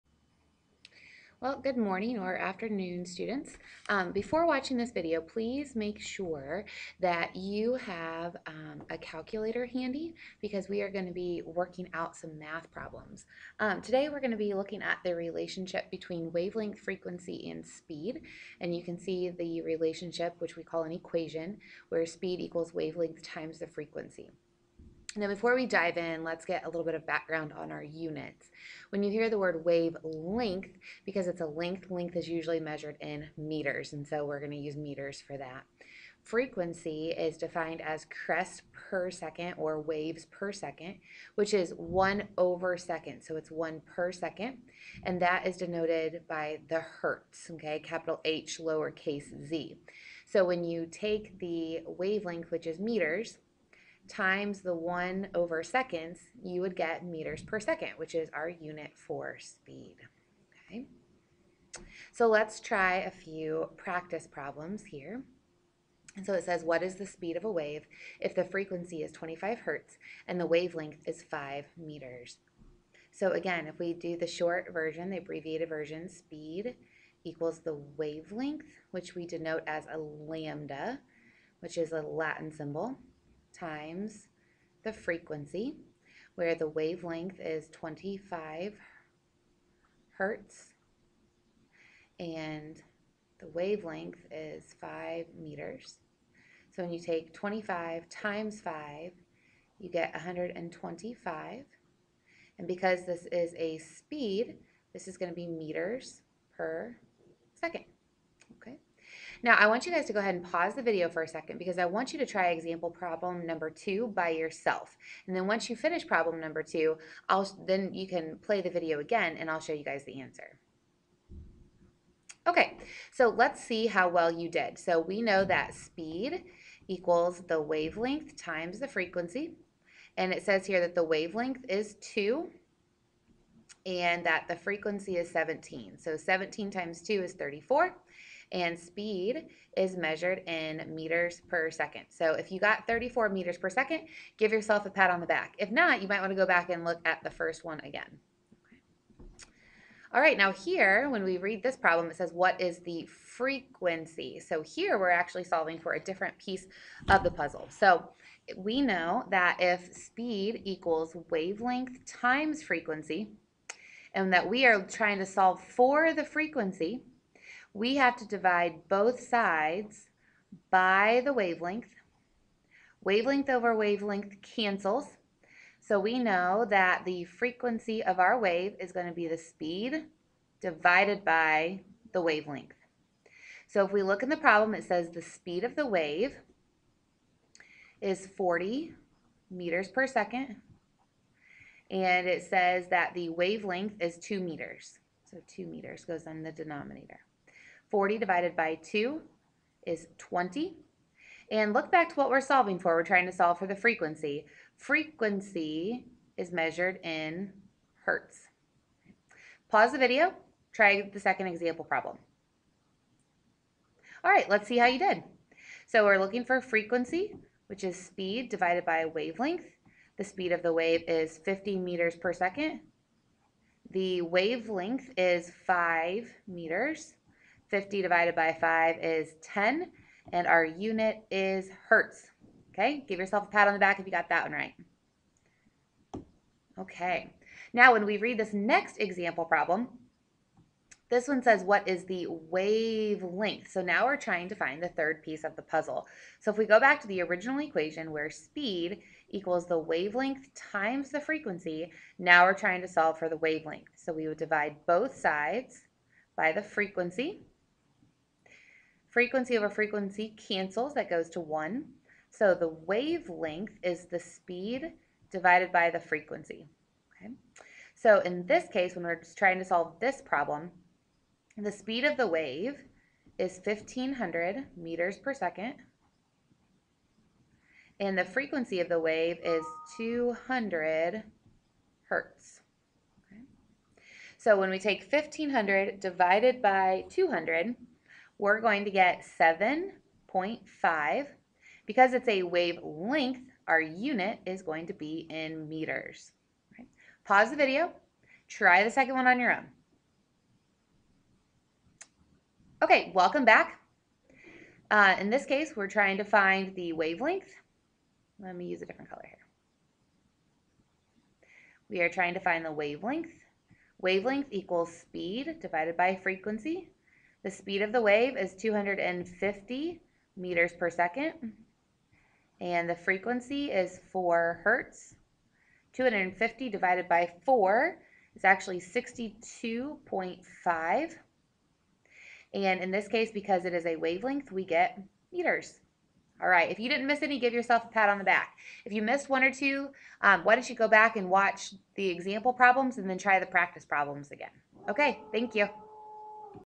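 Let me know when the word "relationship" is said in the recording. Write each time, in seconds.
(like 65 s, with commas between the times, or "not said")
15 s, 19 s.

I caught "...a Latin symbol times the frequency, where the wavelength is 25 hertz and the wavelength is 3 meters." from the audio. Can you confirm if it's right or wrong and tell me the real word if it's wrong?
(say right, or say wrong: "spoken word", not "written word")
wrong: "5", not "3".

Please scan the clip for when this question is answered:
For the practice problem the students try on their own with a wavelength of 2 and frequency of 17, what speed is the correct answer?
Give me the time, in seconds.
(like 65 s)
142 s.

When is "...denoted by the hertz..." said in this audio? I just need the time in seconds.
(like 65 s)
45 s.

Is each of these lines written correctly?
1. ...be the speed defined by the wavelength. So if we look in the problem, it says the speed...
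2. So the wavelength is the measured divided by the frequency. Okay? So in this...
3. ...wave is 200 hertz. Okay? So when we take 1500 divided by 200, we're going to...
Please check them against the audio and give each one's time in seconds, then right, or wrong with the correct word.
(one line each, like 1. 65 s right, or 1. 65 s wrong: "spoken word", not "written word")
1. 179 s wrong: "divided", not "defined"
2. 262 s wrong: "speed", not "measured"
3. 279 s right.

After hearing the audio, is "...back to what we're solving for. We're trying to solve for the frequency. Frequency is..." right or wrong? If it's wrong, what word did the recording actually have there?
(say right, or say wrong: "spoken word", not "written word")
right.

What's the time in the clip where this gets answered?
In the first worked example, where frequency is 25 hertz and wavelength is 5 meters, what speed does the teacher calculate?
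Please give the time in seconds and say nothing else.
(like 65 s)
100 s.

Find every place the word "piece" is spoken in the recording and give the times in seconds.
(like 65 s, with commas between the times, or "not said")
156 s, 245 s.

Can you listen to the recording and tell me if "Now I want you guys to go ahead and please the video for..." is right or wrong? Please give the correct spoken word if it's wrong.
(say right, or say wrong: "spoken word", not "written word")
wrong: "pause", not "please".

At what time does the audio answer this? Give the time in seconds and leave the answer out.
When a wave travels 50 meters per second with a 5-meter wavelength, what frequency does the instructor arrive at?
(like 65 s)
229 s.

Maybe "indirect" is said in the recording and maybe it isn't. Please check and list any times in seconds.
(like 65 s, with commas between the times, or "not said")
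not said.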